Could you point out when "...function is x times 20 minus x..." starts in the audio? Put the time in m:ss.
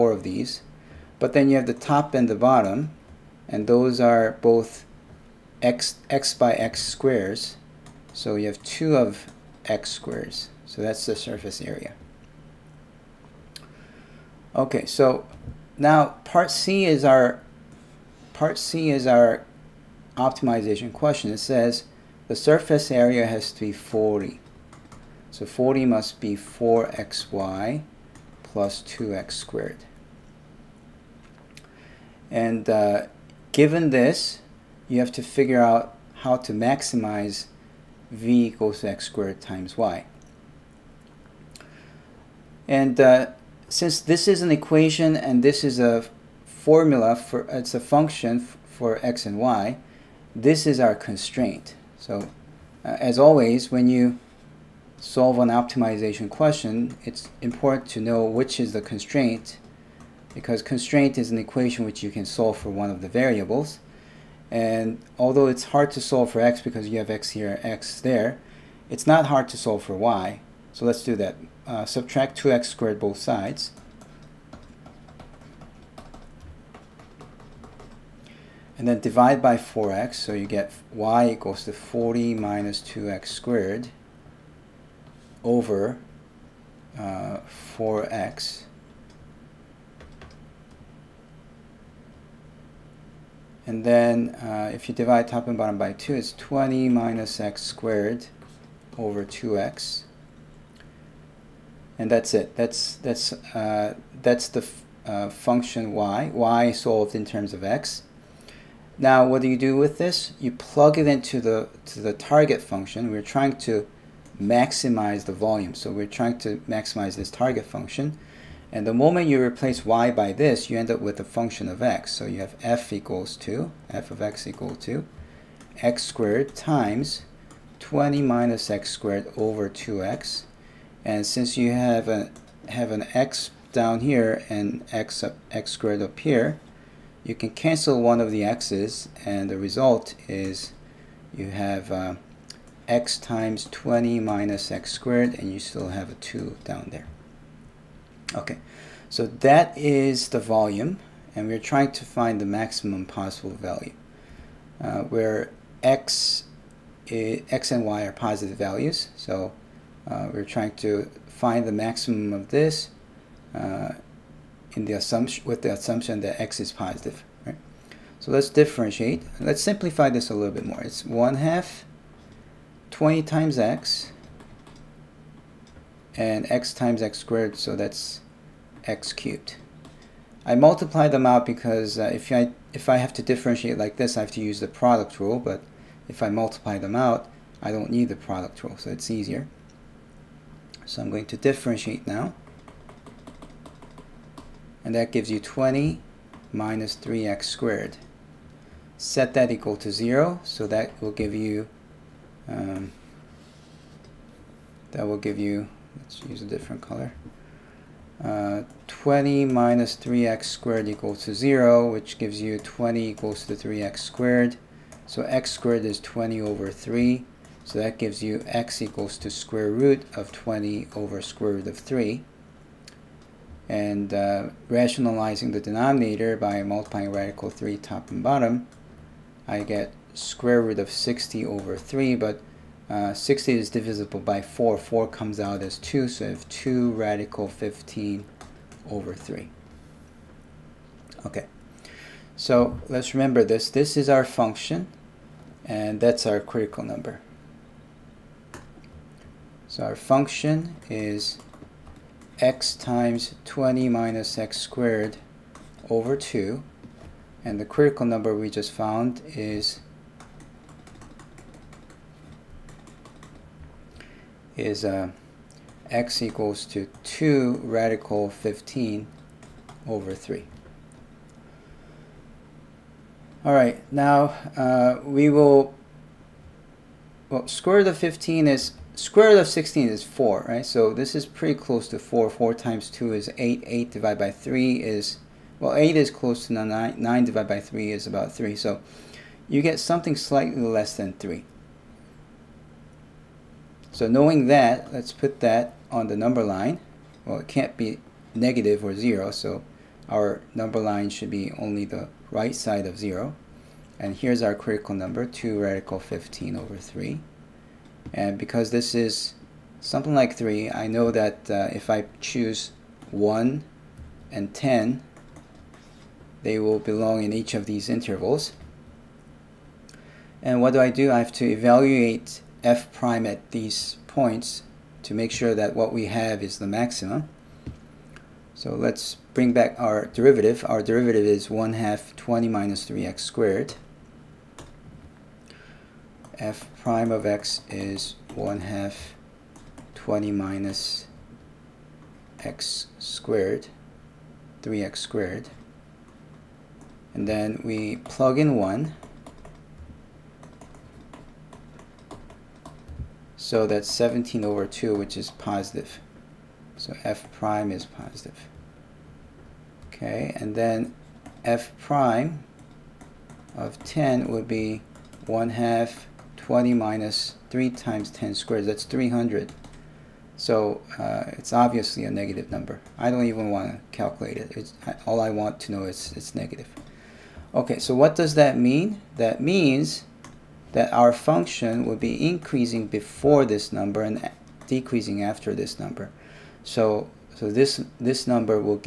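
4:09.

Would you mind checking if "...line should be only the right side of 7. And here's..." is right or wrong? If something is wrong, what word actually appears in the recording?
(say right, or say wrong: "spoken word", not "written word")
wrong: "0", not "7".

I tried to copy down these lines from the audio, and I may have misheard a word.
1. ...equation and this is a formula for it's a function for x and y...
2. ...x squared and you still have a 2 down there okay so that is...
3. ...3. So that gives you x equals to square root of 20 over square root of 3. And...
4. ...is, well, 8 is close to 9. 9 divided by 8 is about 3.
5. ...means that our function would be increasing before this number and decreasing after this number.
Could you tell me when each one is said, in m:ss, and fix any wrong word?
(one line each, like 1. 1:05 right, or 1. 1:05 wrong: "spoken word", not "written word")
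1. 0:44 right
2. 2:24 right
3. 3:36 right
4. 4:44 wrong: "3", not "8"
5. 6:19 right.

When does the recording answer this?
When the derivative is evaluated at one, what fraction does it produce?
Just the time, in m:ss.
5:53.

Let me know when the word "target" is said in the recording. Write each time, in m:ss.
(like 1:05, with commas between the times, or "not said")
1:52, 1:57.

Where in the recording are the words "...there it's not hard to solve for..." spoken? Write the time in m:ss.
1:07.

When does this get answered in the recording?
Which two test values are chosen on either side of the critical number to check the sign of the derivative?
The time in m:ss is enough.
5:13.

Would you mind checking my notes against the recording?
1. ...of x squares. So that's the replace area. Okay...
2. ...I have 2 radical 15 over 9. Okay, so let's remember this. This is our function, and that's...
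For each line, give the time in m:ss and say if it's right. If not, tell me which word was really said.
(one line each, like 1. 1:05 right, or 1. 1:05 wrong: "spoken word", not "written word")
1. 0:08 wrong: "surface", not "replace"
2. 3:56 wrong: "3", not "9".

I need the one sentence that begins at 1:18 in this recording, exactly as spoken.
And then divide by 4x, so you get y equals to 40 minus 2x squared over uh, 4x.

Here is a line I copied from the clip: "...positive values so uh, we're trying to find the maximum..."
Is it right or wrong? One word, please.
right.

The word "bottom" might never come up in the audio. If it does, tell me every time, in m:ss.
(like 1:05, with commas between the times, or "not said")
0:02, 1:35, 3:48.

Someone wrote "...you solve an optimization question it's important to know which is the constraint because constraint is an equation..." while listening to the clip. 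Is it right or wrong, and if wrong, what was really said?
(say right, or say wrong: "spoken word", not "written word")
right.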